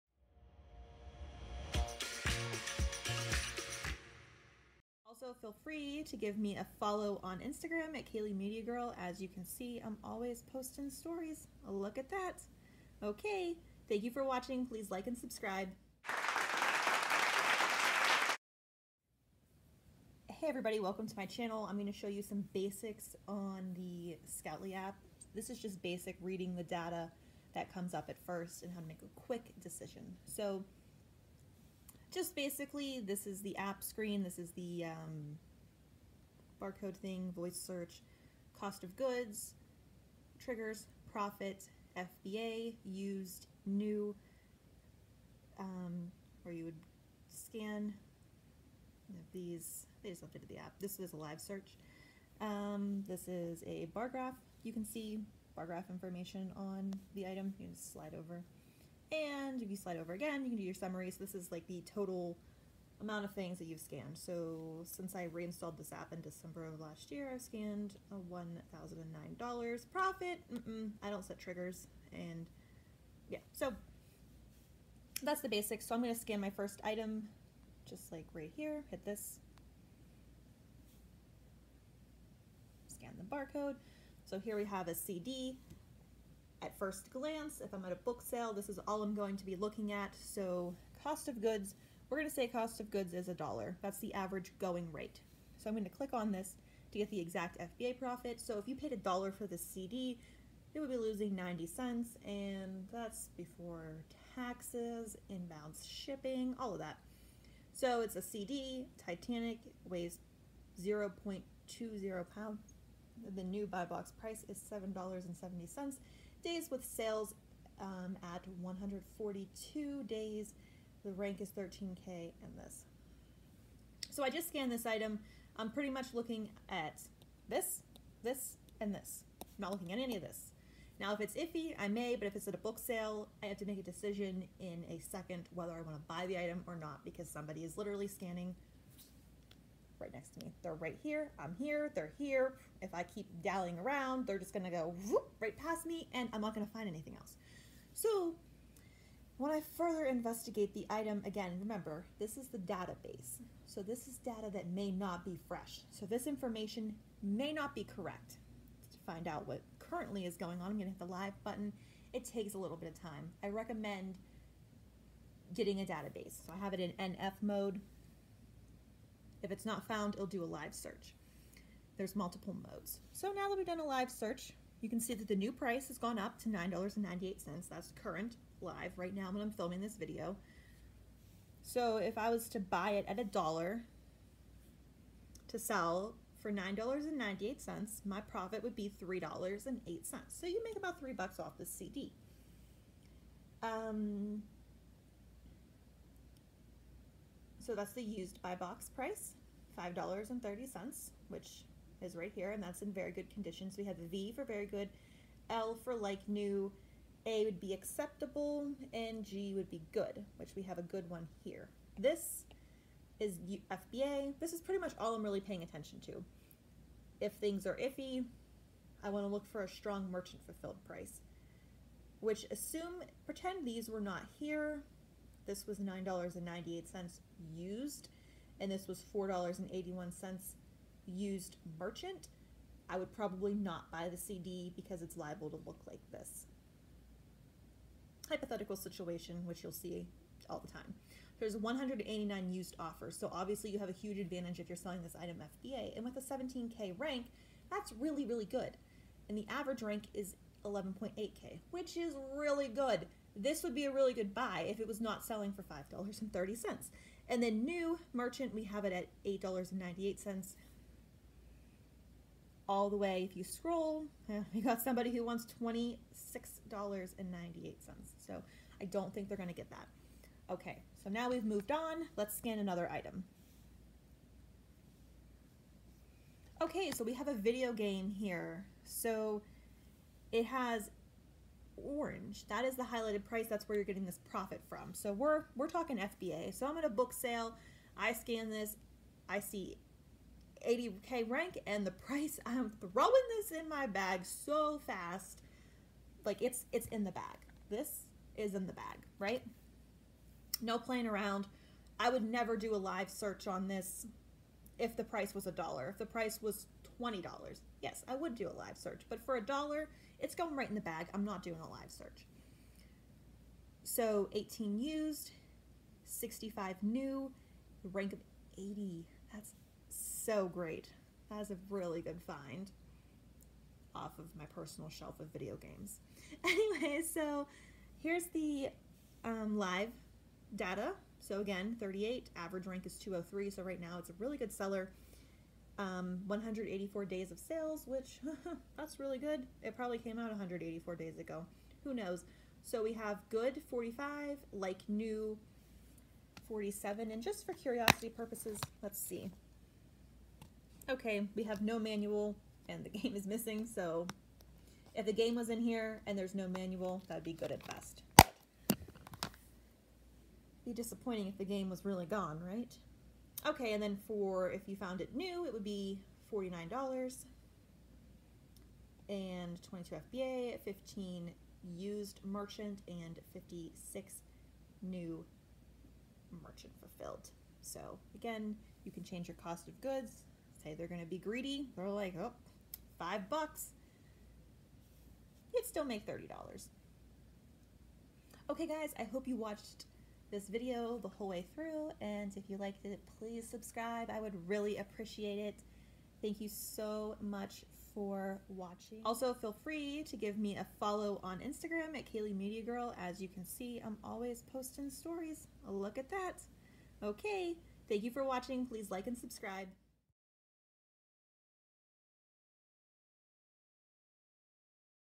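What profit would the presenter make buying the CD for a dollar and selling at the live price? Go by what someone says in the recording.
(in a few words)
$3.08.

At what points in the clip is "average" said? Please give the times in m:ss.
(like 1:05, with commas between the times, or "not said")
1:34, 4:09, 5:32.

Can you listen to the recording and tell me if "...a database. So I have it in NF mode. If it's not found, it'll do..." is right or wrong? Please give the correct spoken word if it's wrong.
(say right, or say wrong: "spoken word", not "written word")
right.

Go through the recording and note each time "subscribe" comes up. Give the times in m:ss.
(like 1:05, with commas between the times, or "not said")
0:15, 6:33, 6:49.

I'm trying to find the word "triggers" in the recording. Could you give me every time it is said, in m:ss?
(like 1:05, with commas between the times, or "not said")
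0:40, 1:11.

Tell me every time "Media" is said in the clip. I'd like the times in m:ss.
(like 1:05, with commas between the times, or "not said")
0:08, 6:42.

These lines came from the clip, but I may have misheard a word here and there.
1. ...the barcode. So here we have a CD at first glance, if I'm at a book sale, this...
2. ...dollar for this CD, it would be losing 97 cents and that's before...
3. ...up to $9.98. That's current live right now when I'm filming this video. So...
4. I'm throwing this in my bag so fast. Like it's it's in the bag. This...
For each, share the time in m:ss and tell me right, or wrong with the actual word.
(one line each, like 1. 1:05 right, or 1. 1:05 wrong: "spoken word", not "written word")
1. 1:23 right
2. 1:38 wrong: "90", not "97"
3. 2:56 right
4. 4:52 right.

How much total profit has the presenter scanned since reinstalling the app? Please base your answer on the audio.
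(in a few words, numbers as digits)
$1,009.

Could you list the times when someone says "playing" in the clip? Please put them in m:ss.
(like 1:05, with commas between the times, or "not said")
5:00.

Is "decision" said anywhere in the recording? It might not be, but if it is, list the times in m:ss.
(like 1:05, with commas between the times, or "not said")
0:29, 2:13.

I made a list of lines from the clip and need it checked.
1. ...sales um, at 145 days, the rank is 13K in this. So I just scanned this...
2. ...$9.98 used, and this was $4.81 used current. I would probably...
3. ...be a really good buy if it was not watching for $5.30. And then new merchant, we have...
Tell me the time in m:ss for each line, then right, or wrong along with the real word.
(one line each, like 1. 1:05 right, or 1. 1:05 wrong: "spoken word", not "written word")
1. 1:56 wrong: "142", not "145"
2. 3:45 wrong: "merchant", not "current"
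3. 4:13 wrong: "selling", not "watching".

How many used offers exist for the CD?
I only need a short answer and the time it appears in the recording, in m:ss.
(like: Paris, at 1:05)
189, at 4:01.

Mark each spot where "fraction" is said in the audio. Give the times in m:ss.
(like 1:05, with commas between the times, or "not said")
not said.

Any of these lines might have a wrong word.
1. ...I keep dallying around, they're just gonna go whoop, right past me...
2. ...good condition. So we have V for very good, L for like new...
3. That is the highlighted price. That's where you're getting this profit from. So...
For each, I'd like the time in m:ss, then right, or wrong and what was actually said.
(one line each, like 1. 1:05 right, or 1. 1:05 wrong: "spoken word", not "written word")
1. 2:22 right
2. 3:23 right
3. 4:42 right.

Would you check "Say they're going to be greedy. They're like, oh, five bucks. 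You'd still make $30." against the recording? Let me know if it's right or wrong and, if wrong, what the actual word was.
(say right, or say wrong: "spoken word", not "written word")
right.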